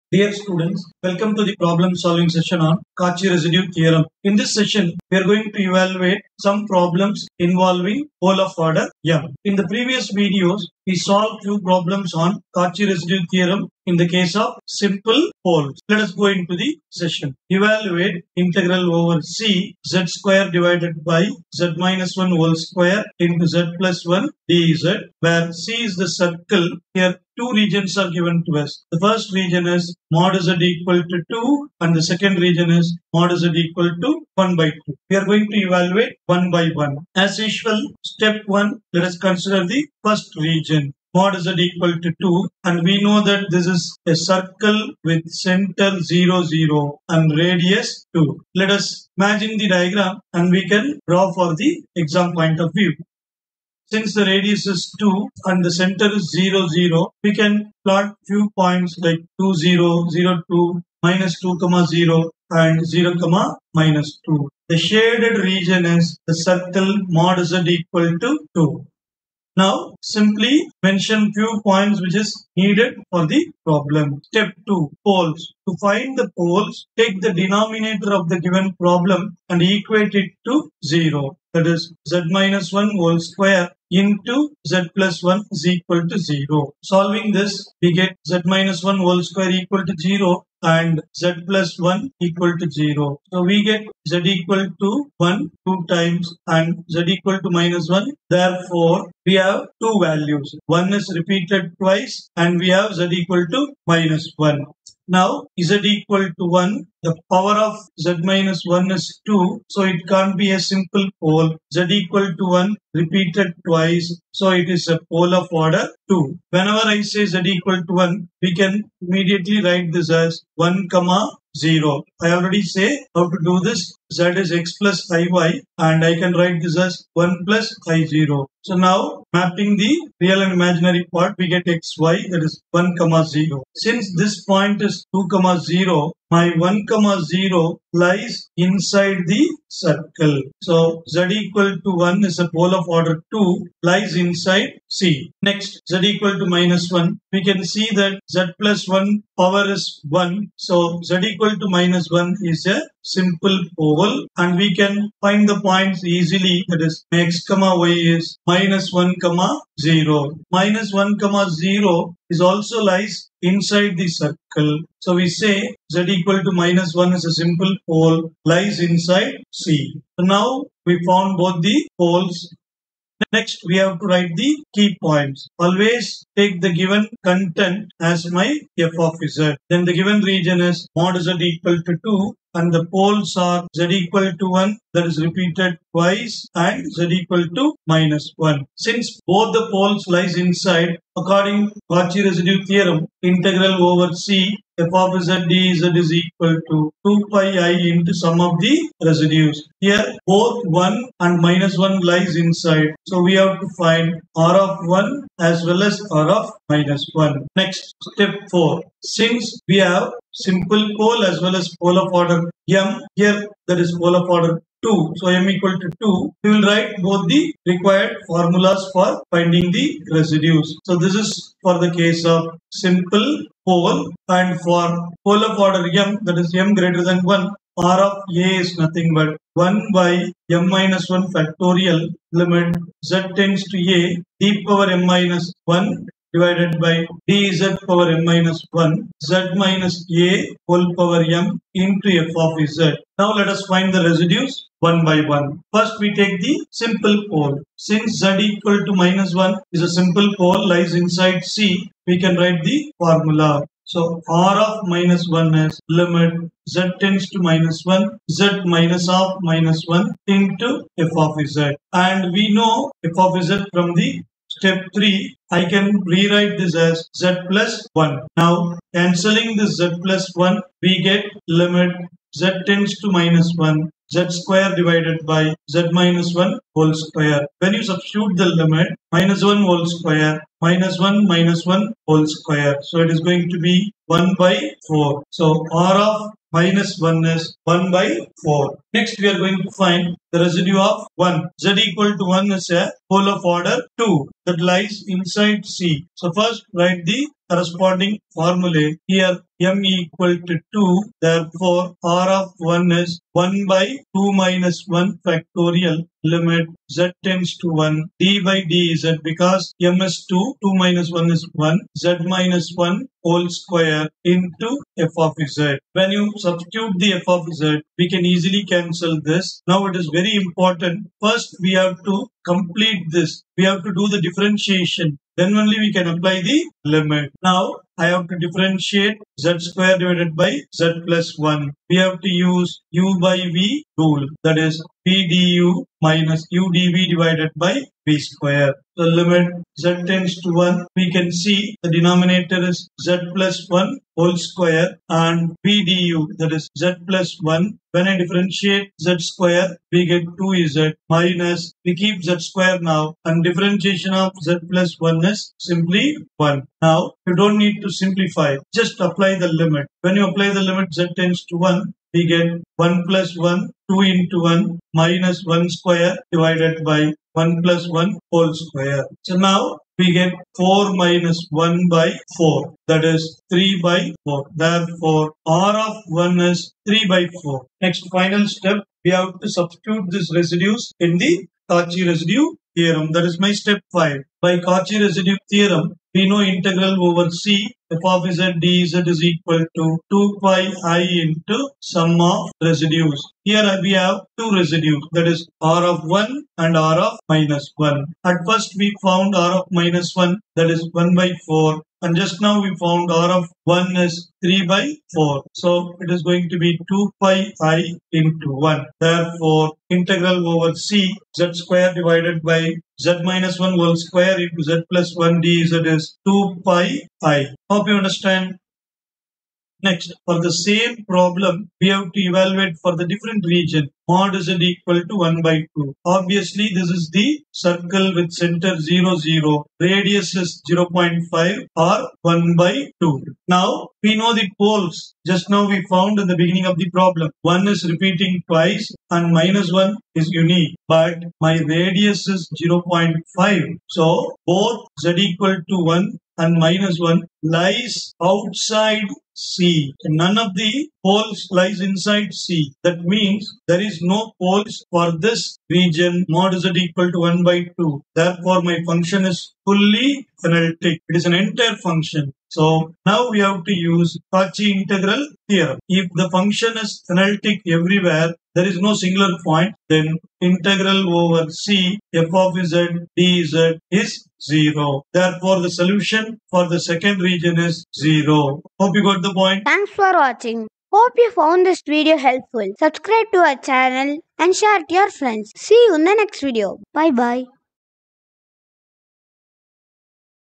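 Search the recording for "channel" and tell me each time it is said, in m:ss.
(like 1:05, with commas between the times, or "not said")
8:03.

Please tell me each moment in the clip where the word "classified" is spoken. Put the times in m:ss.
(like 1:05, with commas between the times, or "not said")
not said.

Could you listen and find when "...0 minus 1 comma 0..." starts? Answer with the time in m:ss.
2:39.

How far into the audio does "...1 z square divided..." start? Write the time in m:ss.
4:33.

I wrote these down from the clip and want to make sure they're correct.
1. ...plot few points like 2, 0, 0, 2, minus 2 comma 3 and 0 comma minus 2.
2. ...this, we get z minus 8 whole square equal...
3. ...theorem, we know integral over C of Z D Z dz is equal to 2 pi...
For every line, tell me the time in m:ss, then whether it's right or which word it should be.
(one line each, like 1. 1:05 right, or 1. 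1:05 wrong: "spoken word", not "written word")
1. 0:57 wrong: "0", not "3"
2. 1:27 wrong: "1", not "8"
3. 6:25 right.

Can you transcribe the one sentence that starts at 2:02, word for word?
I already say how to do this.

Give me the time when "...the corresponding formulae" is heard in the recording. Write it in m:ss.
4:57.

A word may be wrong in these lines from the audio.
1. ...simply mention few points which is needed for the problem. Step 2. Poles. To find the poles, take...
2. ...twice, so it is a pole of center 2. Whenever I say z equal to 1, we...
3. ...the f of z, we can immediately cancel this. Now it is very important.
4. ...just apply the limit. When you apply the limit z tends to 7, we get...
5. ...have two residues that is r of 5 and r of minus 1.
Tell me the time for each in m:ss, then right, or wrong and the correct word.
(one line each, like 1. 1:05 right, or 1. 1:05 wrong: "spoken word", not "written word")
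1. 1:10 right
2. 1:53 wrong: "order", not "center"
3. 5:16 wrong: "easily", not "immediately"
4. 5:58 wrong: "1", not "7"
5. 6:33 wrong: "1", not "5".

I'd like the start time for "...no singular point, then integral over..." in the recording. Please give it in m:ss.
7:48.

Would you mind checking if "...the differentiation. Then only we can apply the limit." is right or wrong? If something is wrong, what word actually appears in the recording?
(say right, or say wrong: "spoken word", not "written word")
right.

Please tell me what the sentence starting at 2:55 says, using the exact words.
Always take the given content as my f of z.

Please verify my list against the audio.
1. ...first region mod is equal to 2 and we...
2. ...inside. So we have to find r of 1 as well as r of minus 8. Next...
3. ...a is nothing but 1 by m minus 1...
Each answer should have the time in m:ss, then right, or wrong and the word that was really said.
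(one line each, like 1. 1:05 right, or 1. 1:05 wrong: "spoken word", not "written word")
1. 0:40 right
2. 3:22 wrong: "1", not "8"
3. 3:48 right.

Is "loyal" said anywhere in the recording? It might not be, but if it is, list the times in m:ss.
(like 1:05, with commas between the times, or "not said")
not said.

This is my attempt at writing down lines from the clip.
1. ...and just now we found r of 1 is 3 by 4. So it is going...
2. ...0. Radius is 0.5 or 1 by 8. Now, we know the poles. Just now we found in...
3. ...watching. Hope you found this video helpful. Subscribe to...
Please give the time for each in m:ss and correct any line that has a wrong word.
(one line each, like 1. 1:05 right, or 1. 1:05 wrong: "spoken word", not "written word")
1. 6:42 right
2. 7:09 wrong: "2", not "8"
3. 8:00 right.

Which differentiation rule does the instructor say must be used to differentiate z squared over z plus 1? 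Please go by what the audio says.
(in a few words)
u by v rule.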